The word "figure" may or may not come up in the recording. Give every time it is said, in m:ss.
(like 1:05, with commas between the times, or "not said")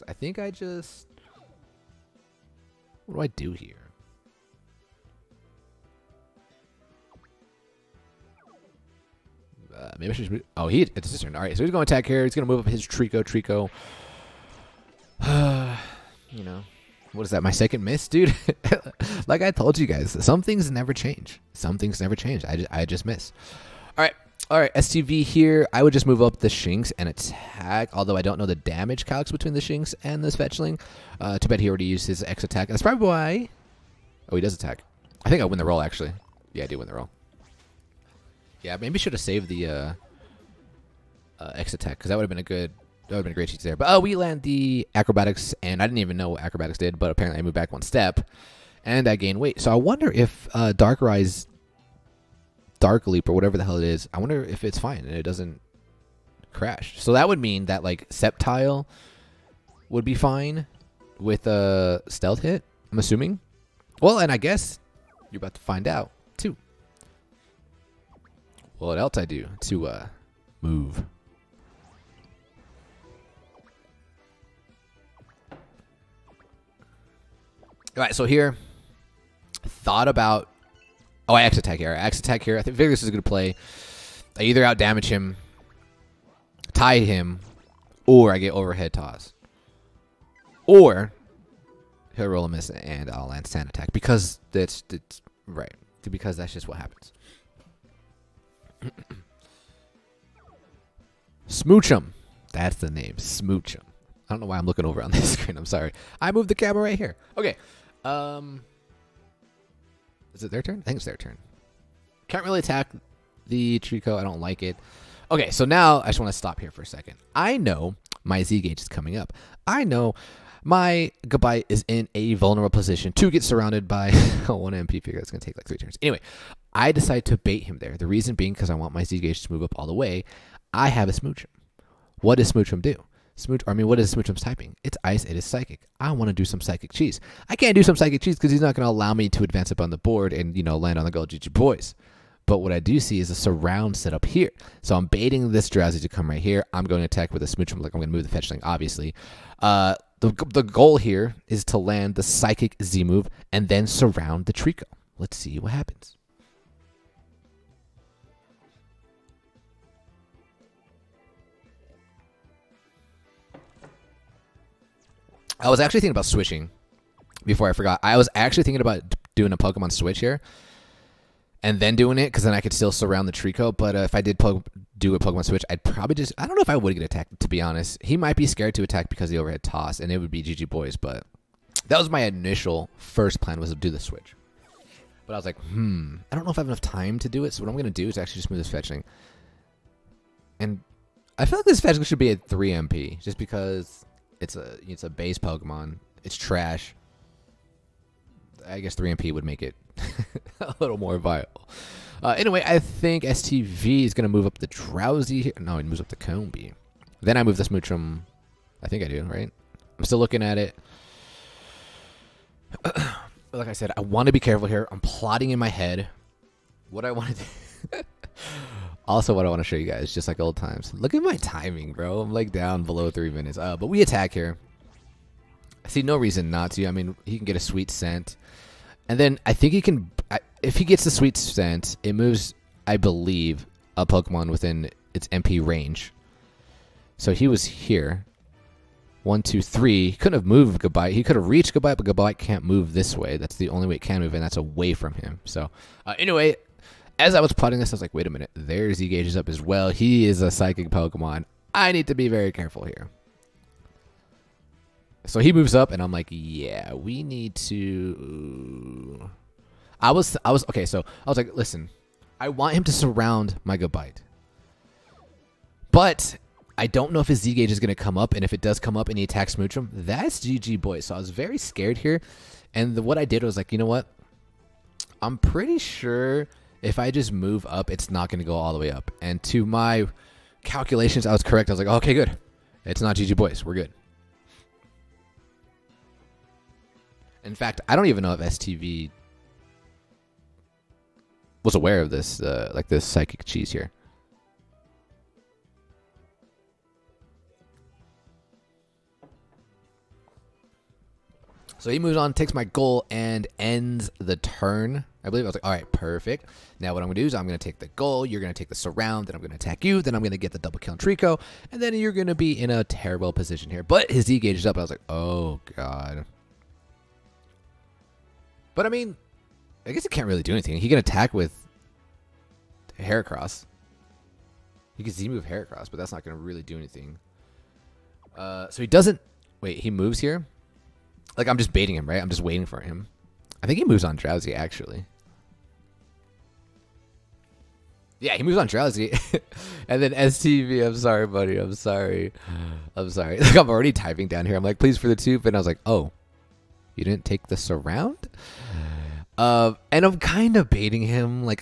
2:05.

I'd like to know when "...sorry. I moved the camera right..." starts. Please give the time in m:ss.
1:45.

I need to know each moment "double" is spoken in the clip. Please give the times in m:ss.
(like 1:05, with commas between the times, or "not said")
5:10.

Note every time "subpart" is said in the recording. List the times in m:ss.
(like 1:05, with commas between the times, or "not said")
not said.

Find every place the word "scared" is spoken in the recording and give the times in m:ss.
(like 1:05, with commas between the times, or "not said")
2:58, 4:31.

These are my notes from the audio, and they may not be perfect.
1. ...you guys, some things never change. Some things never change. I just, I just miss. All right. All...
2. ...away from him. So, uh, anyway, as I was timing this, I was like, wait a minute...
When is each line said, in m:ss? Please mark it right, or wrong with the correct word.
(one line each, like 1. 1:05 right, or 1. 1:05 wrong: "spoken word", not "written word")
1. 0:19 right
2. 4:04 wrong: "plotting", not "timing".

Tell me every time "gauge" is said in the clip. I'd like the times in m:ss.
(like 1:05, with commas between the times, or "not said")
1:58, 2:09, 4:09, 4:27, 5:14.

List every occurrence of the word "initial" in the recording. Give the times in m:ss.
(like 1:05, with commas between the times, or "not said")
3:02.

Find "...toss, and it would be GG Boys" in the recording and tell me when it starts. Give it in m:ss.
2:59.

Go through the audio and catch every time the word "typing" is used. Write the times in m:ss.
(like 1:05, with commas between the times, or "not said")
2:14, 5:43.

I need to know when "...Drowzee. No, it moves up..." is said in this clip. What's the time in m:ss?
3:24.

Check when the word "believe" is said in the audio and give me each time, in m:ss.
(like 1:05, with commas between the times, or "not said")
3:52, 5:05.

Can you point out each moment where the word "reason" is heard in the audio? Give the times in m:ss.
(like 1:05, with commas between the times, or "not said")
2:08, 3:46.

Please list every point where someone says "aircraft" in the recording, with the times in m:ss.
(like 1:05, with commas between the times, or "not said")
not said.